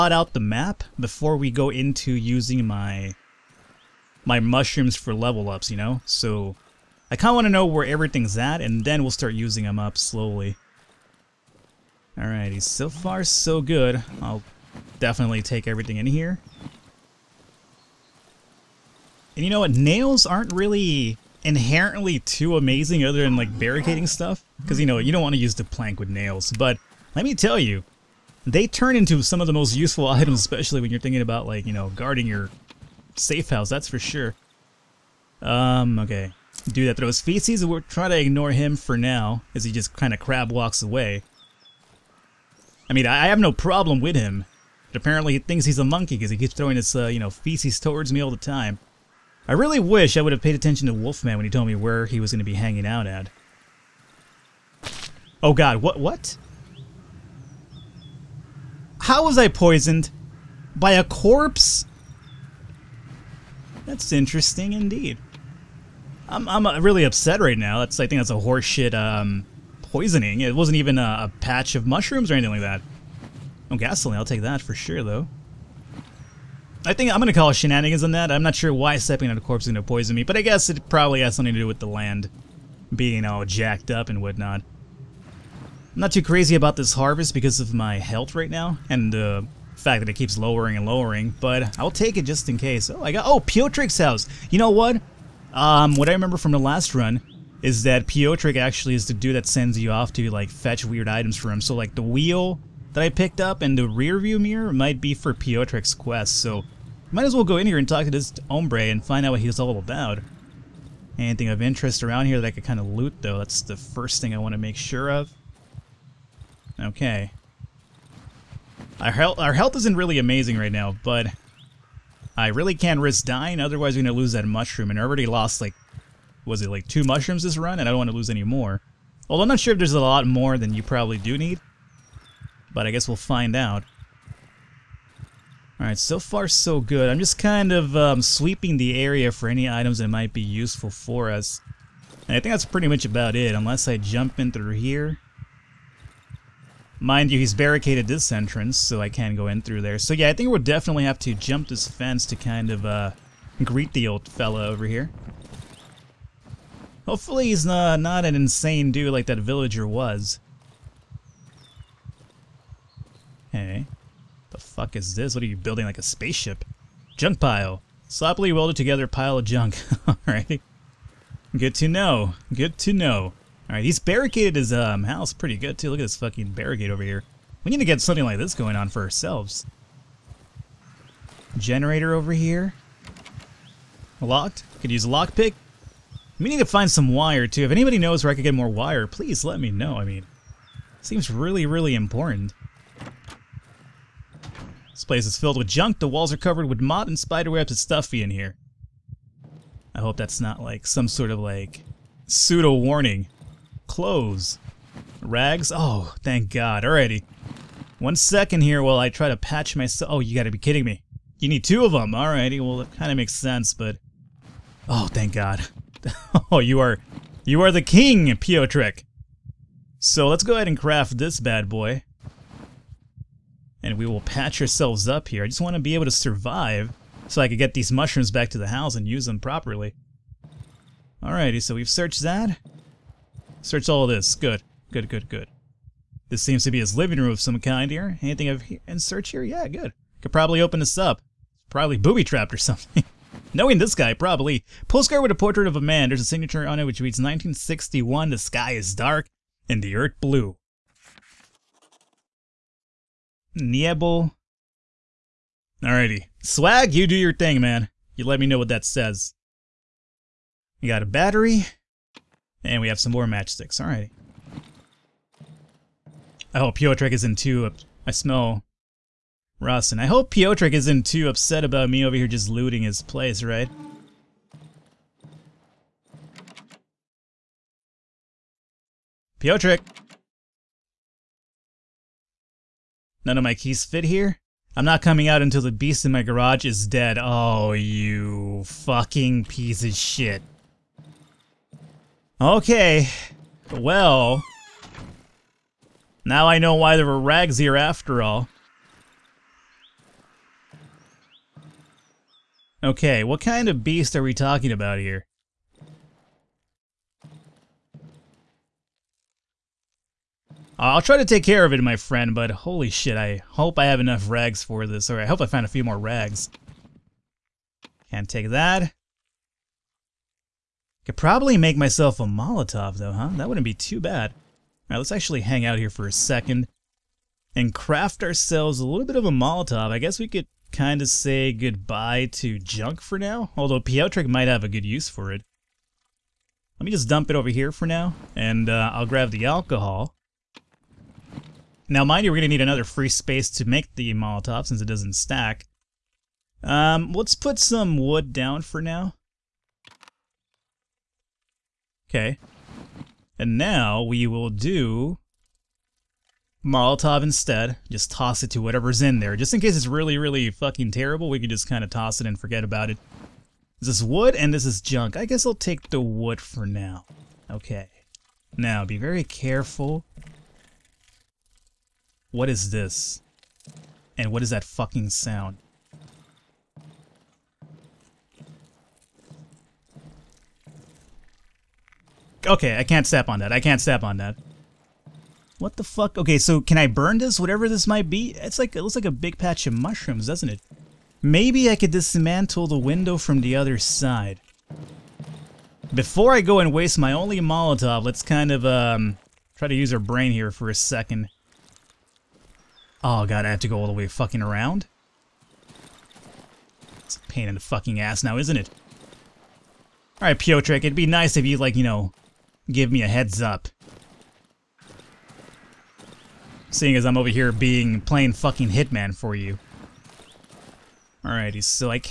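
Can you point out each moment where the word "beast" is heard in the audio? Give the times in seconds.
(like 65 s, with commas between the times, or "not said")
285 s, 303 s.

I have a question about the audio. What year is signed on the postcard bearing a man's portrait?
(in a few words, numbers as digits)
1961.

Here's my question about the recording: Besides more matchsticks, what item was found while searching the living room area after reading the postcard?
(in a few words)
A battery.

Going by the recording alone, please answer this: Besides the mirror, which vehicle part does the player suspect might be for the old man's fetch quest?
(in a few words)
Wheel.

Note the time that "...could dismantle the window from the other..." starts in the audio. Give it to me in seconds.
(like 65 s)
391 s.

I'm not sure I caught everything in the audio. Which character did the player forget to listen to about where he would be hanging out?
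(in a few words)
Wolfman.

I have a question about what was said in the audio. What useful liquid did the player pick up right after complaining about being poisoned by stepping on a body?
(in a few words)
Gasoline.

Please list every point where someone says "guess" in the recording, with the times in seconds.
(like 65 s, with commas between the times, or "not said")
80 s, 132 s, 329 s, 365 s.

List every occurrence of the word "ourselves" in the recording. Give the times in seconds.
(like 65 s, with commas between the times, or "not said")
179 s, 224 s, 328 s.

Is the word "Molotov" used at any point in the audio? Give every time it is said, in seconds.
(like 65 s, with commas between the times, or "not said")
322 s, 329 s, 344 s, 356 s, 397 s.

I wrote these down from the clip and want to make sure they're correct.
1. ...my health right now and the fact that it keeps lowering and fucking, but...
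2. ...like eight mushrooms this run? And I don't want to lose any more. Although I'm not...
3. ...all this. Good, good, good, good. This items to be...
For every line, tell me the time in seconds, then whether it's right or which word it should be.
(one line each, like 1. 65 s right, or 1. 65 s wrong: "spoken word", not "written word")
1. 87 s wrong: "lowering", not "fucking"
2. 126 s wrong: "two", not "eight"
3. 233 s wrong: "seems", not "items".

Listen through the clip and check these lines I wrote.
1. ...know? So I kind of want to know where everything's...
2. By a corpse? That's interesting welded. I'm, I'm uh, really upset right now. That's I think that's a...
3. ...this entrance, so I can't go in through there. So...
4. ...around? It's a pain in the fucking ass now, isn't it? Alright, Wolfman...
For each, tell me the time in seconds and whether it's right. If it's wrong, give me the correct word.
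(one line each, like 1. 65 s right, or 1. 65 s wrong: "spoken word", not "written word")
1. 5 s right
2. 60 s wrong: "indeed", not "welded"
3. 148 s right
4. 404 s wrong: "Piotrek", not "Wolfman".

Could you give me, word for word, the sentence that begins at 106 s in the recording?
So might as well go in here and talk to this hombre and find out what he's all about.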